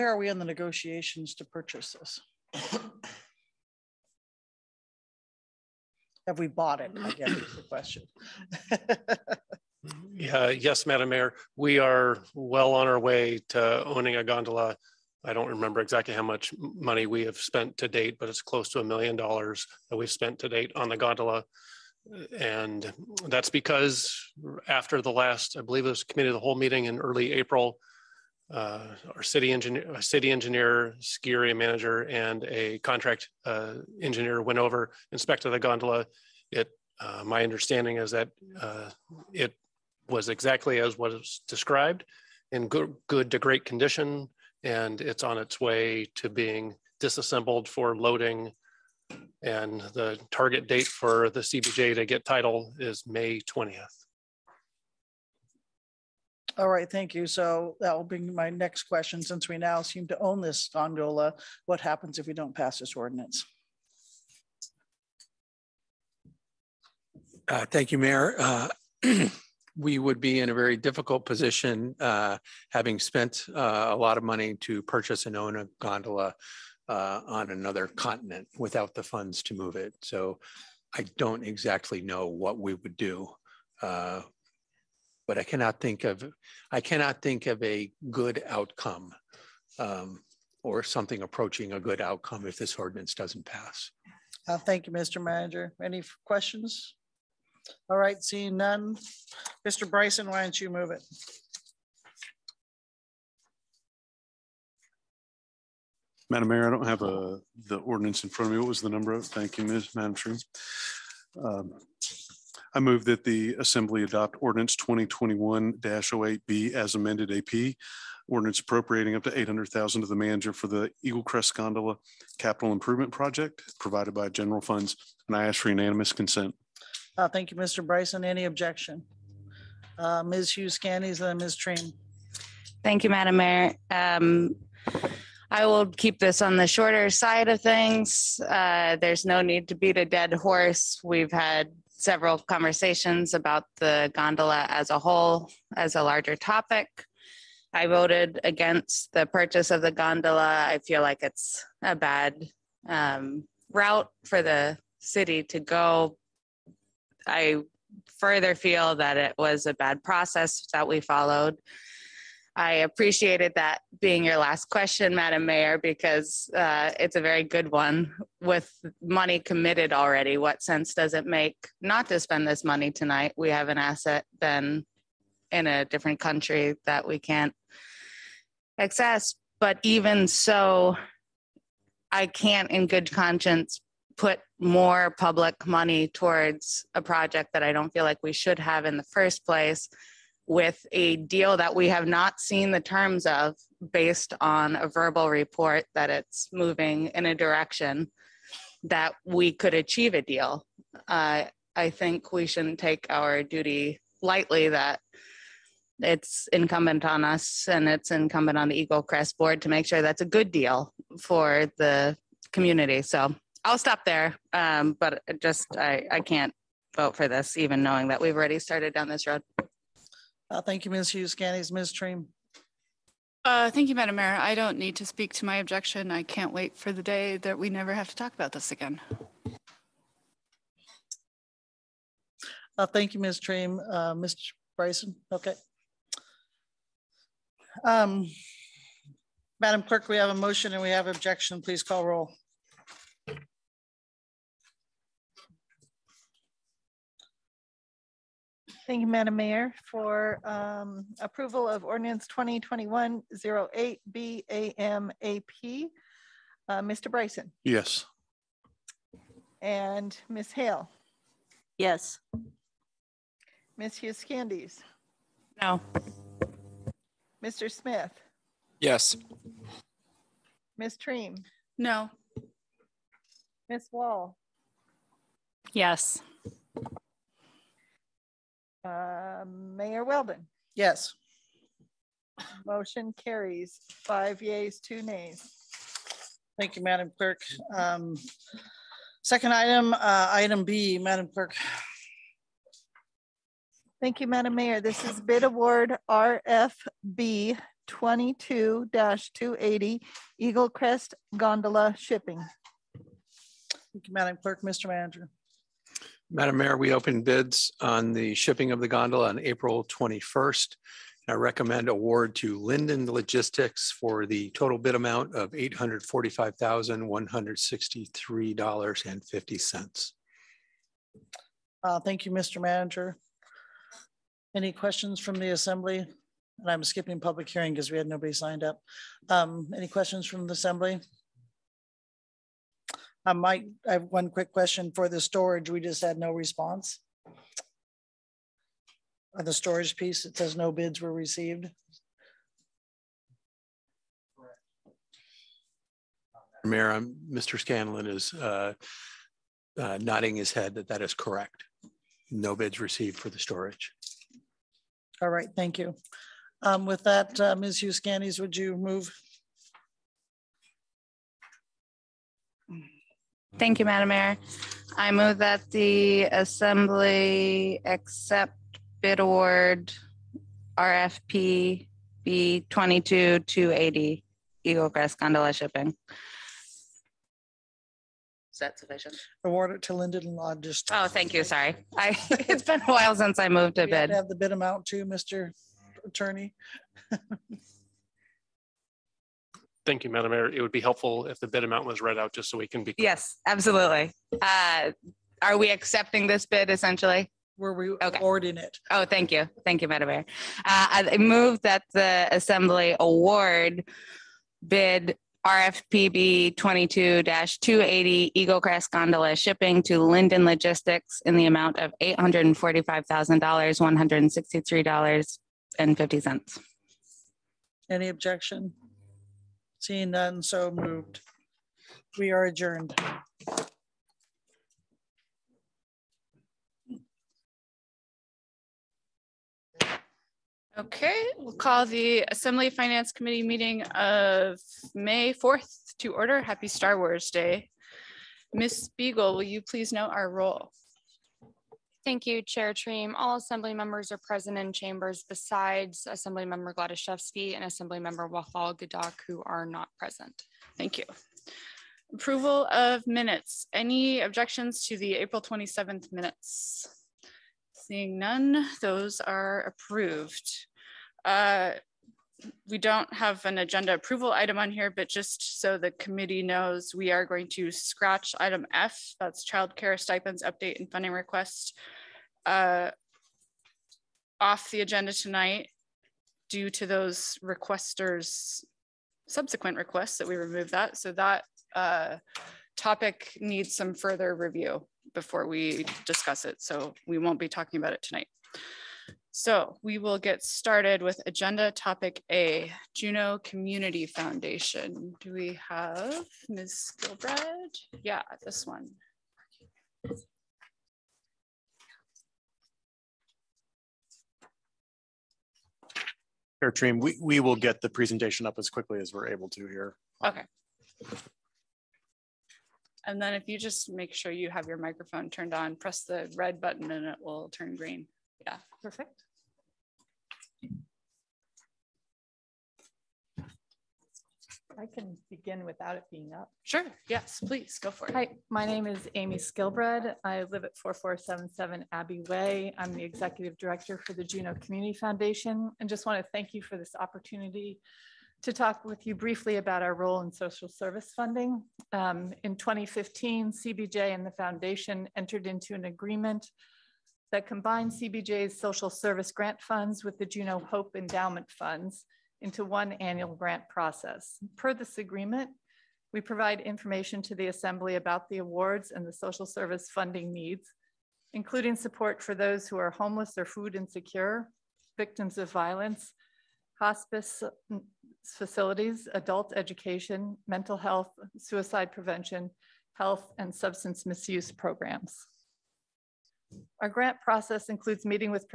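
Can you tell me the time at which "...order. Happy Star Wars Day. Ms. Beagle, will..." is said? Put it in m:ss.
7:16.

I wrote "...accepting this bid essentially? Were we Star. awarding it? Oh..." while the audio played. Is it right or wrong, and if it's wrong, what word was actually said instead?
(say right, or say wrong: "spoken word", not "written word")
wrong: "Okay", not "Star".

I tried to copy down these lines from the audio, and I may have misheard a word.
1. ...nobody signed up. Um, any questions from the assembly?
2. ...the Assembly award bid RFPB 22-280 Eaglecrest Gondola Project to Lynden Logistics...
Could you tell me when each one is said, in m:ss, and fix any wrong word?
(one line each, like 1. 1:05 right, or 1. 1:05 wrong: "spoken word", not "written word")
1. 5:28 right
2. 6:41 wrong: "Shipping", not "Project".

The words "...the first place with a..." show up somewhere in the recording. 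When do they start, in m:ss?
3:08.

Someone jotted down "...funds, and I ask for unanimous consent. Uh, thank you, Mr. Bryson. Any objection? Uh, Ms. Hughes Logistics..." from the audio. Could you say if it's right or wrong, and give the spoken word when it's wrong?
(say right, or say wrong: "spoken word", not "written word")
wrong: "Skandijs", not "Logistics".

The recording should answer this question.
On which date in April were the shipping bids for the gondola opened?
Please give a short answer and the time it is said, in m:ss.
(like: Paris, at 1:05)
April 21st, at 5:09.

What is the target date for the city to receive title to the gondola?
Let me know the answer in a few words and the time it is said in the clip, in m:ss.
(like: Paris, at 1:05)
May 20th, at 0:53.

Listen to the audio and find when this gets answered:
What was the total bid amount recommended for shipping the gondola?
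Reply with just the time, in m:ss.
5:15.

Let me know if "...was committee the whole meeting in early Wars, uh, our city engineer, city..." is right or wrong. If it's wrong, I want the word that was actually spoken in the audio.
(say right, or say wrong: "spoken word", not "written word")
wrong: "April", not "Wars".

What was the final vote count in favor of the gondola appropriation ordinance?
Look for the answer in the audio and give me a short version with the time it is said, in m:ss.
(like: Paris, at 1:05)
5, at 4:44.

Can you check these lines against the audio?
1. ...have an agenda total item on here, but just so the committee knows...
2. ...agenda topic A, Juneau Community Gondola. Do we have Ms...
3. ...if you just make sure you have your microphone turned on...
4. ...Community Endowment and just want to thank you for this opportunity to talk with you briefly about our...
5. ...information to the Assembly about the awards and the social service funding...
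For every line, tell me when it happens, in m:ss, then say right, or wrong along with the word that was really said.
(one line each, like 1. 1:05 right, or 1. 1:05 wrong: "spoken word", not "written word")
1. 7:43 wrong: "approval", not "total"
2. 8:11 wrong: "Foundation", not "Gondola"
3. 8:33 right
4. 8:54 wrong: "Foundation", not "Endowment"
5. 9:16 right.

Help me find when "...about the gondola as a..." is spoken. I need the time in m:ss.
2:23.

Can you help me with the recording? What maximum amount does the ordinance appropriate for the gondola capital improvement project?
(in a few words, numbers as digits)
800,000.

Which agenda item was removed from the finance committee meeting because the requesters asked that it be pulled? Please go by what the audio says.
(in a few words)
childcare stipends update.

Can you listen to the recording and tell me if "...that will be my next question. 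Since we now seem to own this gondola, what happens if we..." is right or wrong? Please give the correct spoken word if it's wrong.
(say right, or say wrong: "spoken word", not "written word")
right.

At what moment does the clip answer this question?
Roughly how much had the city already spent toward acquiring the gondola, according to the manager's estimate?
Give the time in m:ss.
0:18.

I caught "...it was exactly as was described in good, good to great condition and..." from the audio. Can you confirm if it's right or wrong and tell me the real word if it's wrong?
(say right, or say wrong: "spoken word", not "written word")
right.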